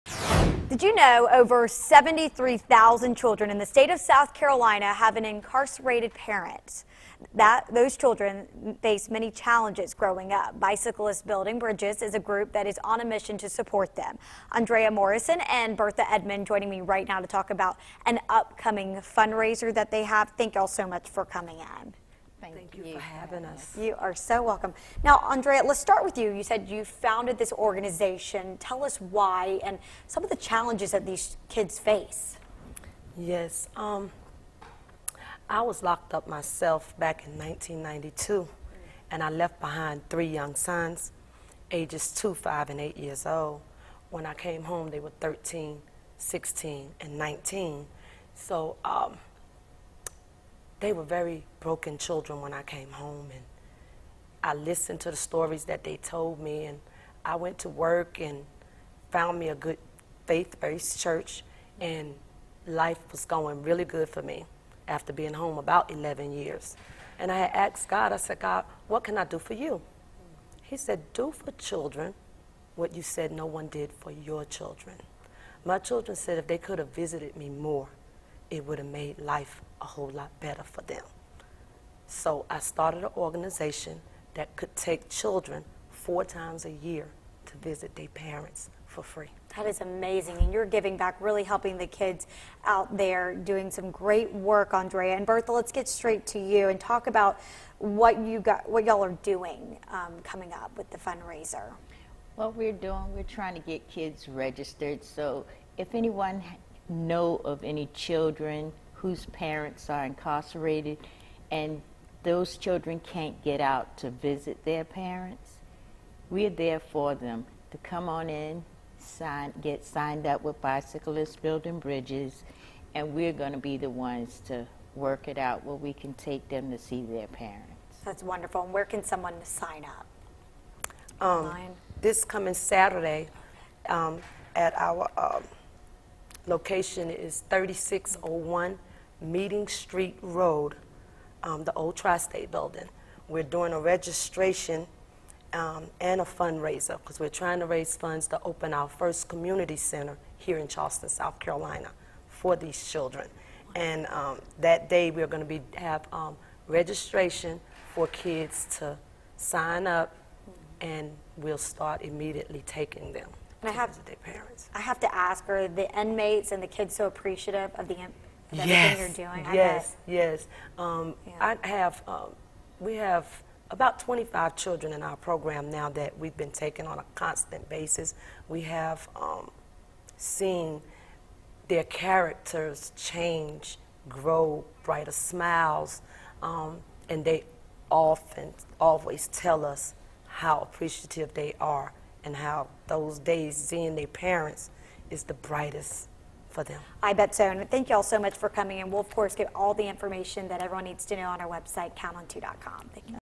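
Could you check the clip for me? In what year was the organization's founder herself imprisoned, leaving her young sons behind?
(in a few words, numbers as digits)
1992.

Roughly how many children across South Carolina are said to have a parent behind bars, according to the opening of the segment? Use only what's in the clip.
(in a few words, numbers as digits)
73,000.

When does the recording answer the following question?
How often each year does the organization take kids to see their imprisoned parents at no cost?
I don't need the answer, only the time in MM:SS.
01:25.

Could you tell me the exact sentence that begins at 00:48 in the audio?
So, um, they were very broken children when I came home.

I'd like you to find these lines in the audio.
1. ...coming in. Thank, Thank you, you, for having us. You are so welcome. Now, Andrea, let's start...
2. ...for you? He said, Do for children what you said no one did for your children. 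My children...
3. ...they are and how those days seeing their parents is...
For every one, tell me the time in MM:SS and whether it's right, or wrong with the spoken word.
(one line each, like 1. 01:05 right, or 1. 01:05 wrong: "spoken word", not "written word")
1. 00:21 right
2. 01:09 right
3. 03:11 right.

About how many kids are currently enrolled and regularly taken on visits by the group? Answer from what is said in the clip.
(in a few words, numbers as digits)
25.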